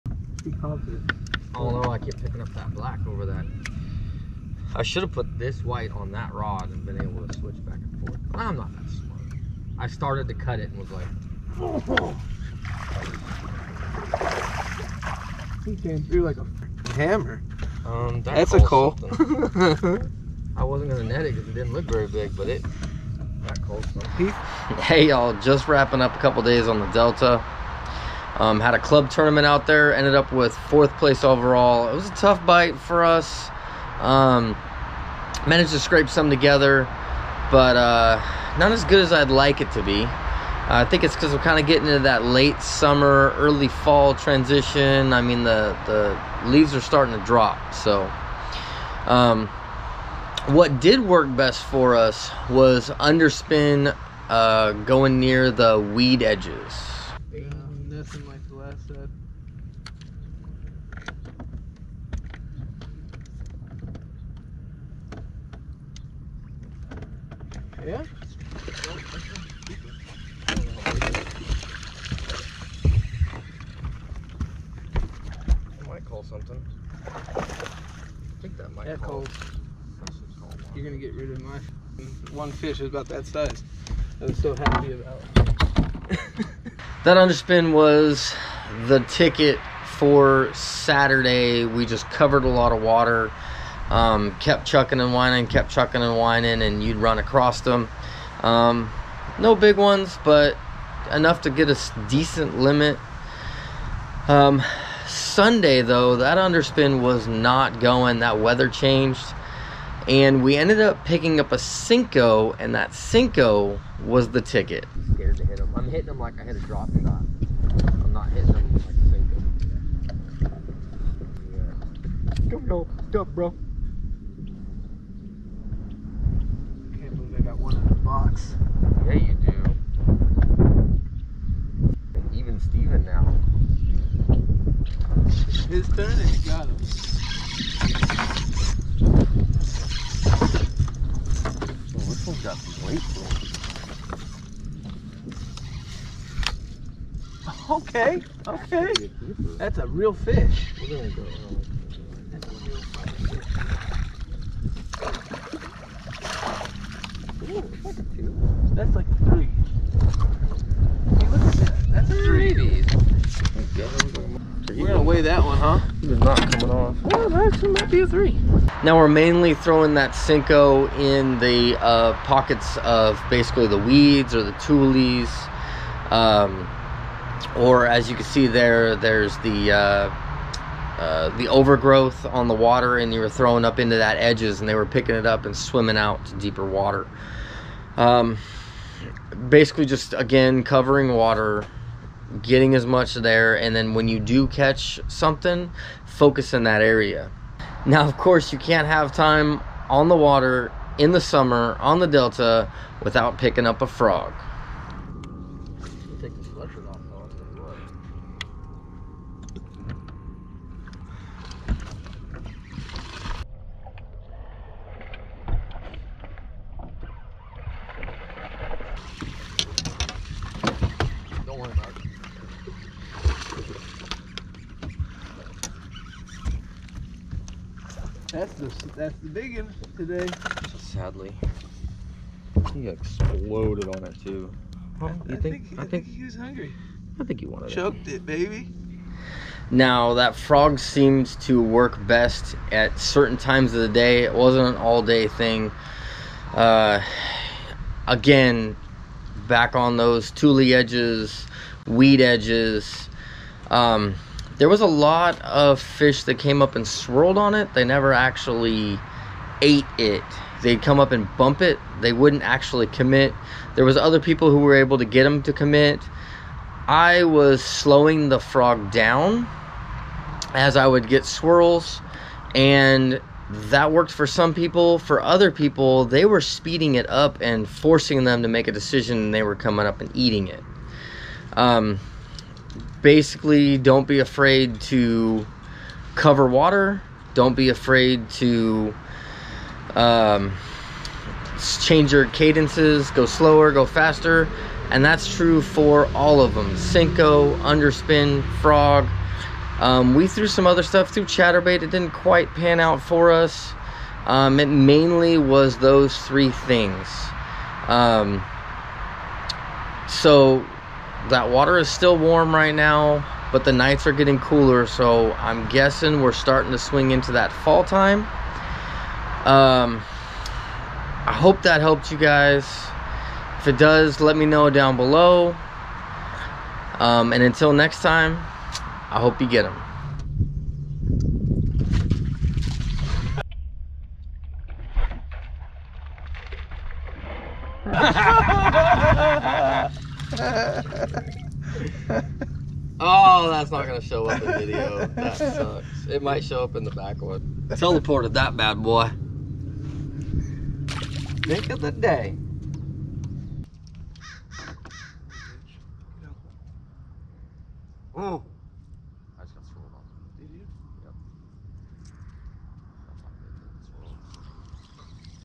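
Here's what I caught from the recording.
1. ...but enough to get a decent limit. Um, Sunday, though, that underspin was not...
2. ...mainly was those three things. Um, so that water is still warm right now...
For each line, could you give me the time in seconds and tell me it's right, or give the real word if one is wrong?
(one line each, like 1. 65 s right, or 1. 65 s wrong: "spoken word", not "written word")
1. 100 s right
2. 304 s right.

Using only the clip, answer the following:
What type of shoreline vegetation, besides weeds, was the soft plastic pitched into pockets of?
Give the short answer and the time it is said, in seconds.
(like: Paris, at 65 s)
Tules, at 174 s.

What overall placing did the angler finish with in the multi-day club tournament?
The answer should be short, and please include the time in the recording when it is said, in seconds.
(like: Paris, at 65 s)
4th place, at 30 s.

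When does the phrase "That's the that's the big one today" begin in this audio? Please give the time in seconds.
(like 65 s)
228 s.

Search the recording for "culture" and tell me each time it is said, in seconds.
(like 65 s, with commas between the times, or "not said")
not said.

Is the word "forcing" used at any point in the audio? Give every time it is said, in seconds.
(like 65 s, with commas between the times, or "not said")
277 s.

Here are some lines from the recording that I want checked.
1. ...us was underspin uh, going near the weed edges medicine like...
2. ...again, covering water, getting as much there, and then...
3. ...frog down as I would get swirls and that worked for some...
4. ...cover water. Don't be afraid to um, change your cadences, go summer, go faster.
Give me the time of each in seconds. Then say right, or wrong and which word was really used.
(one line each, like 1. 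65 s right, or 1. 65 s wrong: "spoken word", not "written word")
1. 51 s right
2. 190 s right
3. 268 s right
4. 286 s wrong: "slower", not "summer".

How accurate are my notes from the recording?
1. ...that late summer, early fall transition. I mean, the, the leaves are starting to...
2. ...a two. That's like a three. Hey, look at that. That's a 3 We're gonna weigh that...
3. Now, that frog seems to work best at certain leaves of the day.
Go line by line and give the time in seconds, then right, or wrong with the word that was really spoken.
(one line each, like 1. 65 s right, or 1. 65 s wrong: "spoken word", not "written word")
1. 41 s right
2. 159 s right
3. 239 s wrong: "times", not "leaves".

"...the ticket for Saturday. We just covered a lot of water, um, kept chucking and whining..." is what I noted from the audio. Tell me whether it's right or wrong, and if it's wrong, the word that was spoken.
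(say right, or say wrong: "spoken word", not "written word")
right.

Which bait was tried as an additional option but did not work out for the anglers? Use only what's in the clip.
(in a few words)
Chatterbait.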